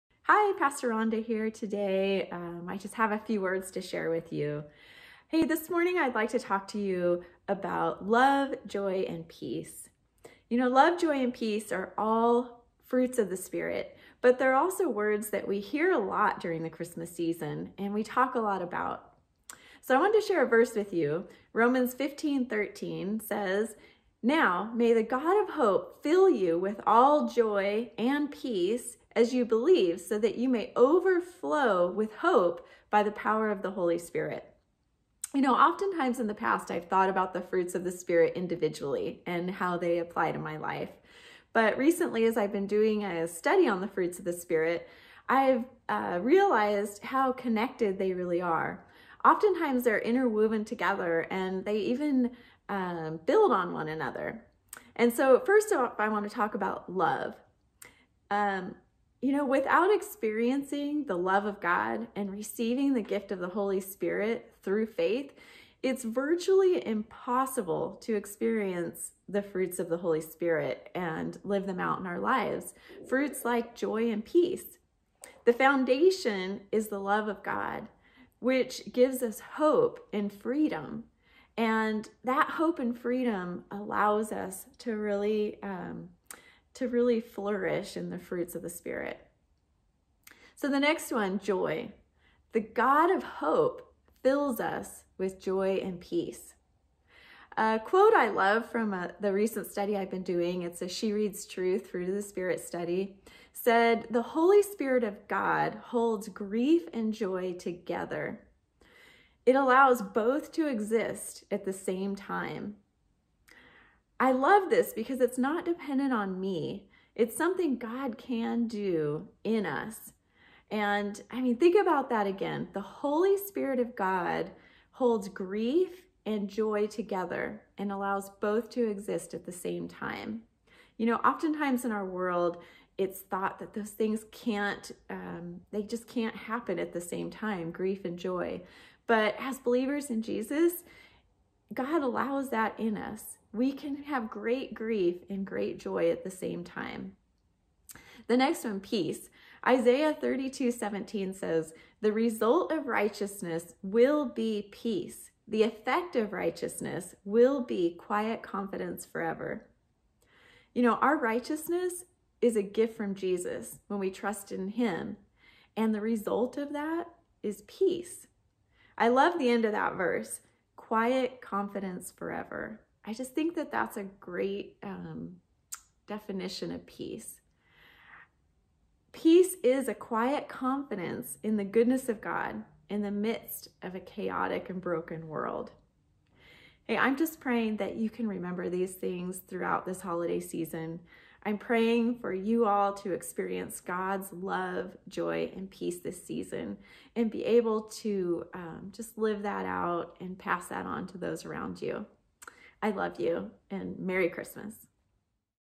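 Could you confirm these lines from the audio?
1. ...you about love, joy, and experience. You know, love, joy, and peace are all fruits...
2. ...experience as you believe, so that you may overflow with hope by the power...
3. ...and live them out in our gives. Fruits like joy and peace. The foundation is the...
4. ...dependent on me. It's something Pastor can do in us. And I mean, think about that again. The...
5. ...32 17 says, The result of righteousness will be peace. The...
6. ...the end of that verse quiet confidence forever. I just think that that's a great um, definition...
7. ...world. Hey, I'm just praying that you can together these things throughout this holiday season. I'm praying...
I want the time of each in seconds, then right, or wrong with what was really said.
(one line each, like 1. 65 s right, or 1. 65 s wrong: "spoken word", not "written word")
1. 6 s wrong: "peace", not "experience"
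2. 28 s wrong: "peace", not "experience"
3. 70 s wrong: "lives", not "gives"
4. 115 s wrong: "God", not "Pastor"
5. 150 s right
6. 169 s right
7. 185 s wrong: "remember", not "together".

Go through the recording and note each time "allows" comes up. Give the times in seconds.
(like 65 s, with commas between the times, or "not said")
83 s, 109 s, 127 s, 142 s.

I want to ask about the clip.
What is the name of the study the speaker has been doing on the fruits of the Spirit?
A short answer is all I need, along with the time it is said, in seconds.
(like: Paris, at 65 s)
She Reads Truth, at 100 s.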